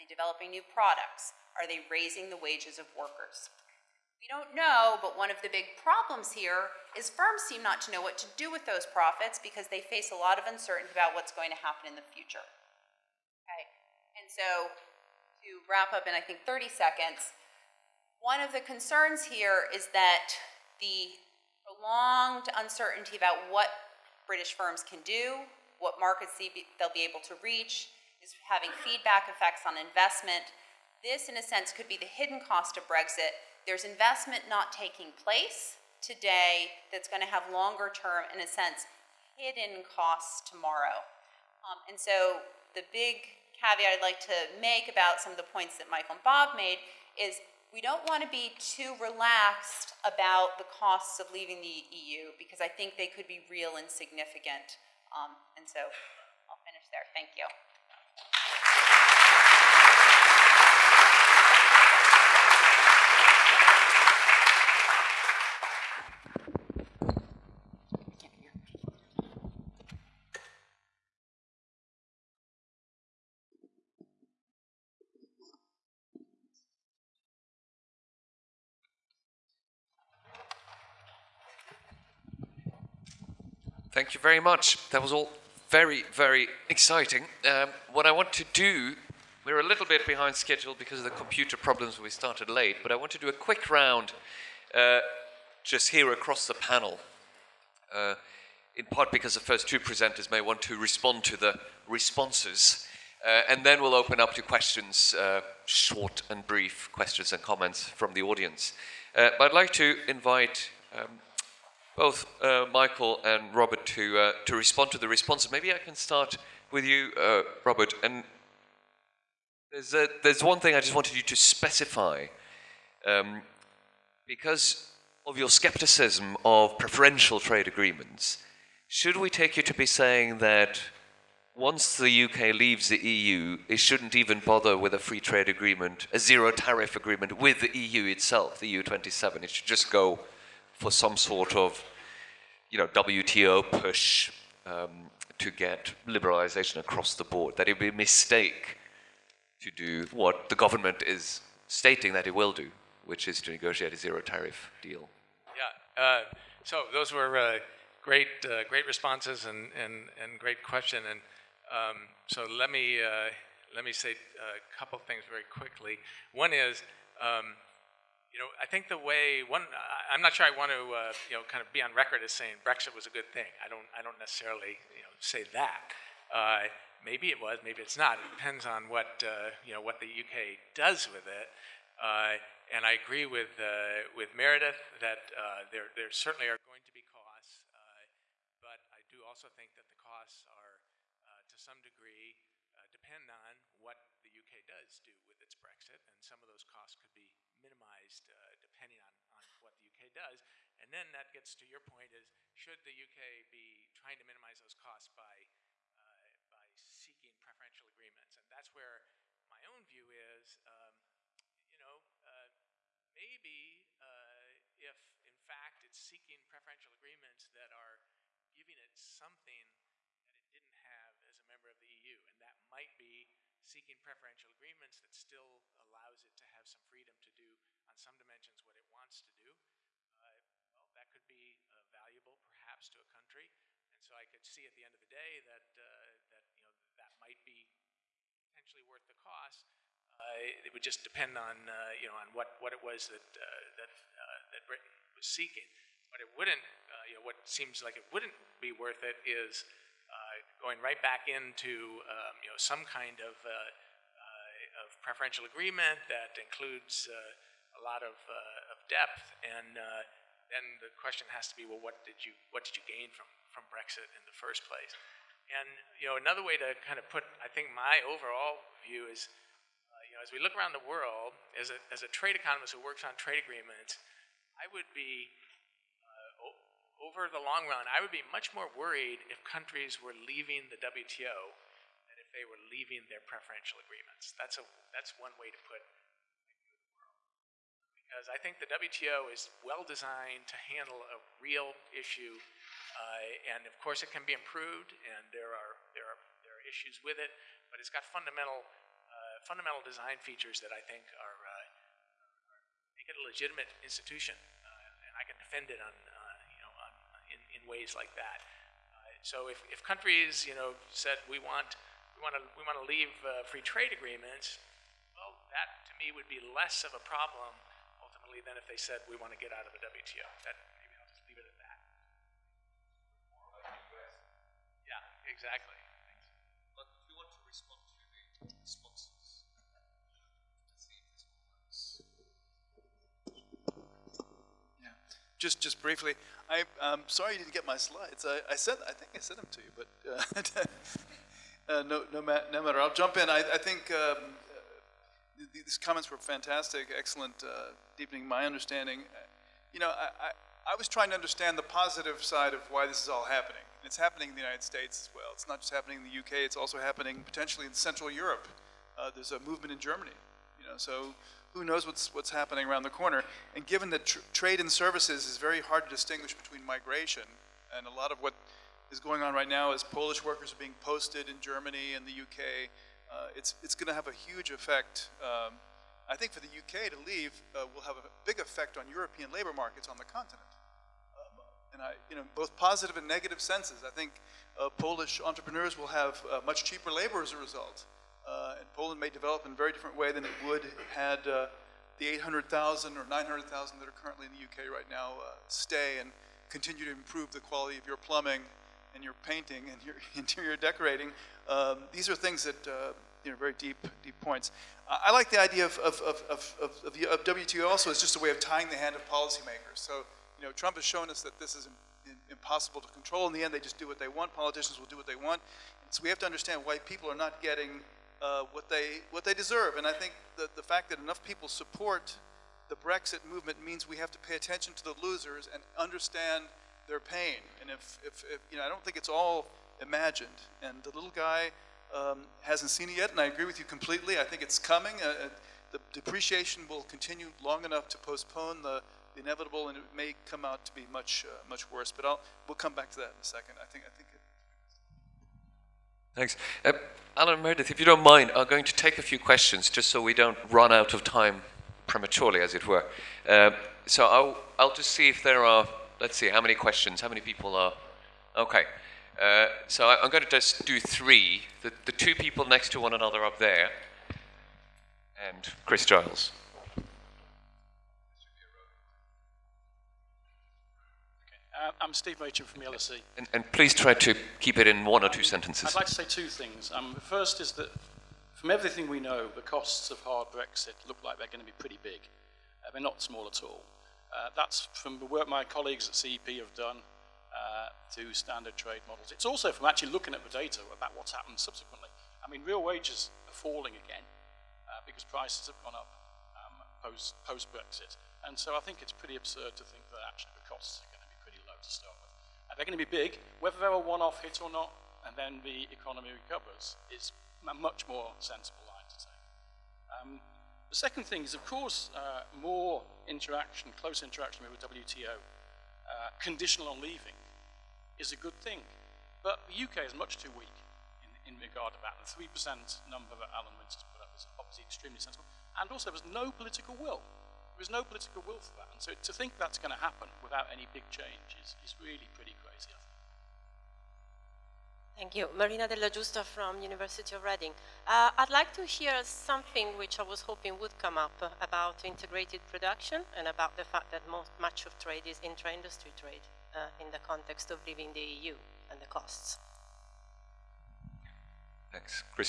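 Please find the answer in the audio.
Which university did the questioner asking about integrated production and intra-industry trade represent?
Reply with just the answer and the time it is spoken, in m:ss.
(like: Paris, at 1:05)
University of Reading, at 8:56.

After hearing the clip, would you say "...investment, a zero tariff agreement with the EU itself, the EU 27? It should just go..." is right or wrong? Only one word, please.
wrong.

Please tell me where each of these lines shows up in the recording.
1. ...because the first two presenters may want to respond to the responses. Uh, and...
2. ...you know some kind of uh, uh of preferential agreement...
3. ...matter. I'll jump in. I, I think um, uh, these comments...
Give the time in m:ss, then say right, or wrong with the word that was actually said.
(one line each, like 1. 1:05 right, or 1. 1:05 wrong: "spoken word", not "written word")
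1. 1:39 right
2. 4:12 right
3. 5:42 right.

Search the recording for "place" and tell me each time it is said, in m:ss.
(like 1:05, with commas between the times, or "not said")
0:35, 4:24.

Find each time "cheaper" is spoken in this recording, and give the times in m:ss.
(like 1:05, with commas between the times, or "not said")
6:26.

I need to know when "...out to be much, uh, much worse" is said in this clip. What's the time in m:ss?
7:20.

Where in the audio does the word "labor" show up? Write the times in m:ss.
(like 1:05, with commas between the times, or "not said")
6:19, 6:26.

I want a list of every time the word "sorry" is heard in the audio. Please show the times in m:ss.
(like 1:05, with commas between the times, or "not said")
5:37.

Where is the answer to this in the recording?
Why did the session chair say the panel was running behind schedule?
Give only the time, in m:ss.
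1:31.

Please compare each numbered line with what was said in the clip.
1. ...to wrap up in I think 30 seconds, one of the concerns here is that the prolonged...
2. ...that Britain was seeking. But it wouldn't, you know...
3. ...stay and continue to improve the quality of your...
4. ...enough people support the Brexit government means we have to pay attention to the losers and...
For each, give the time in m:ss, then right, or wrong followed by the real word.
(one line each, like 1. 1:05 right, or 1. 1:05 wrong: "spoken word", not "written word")
1. 0:14 right
2. 4:04 right
3. 6:35 right
4. 7:00 wrong: "movement", not "government".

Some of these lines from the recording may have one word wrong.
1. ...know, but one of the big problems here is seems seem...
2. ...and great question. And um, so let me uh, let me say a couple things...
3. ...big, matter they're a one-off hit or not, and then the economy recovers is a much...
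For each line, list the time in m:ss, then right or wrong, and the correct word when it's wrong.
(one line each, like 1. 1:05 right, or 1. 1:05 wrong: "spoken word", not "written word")
1. 0:04 wrong: "firms", not "seems"
2. 2:40 right
3. 8:22 wrong: "whether", not "matter".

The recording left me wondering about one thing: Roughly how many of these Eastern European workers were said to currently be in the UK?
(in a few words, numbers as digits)
800,000 or 900,000.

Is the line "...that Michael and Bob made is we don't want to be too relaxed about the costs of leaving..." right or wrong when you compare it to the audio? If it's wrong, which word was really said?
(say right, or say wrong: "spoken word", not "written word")
right.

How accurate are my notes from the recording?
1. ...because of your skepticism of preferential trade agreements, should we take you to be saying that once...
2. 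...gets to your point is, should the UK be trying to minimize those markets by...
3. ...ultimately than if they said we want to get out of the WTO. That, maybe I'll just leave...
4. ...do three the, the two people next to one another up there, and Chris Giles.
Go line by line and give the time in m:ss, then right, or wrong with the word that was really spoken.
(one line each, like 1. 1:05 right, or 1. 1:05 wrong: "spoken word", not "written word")
1. 2:04 right
2. 3:21 wrong: "costs", not "markets"
3. 5:18 right
4. 7:40 right.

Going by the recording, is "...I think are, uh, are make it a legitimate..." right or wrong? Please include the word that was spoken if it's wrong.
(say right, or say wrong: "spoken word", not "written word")
right.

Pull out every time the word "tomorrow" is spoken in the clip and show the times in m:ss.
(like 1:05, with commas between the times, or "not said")
0:40.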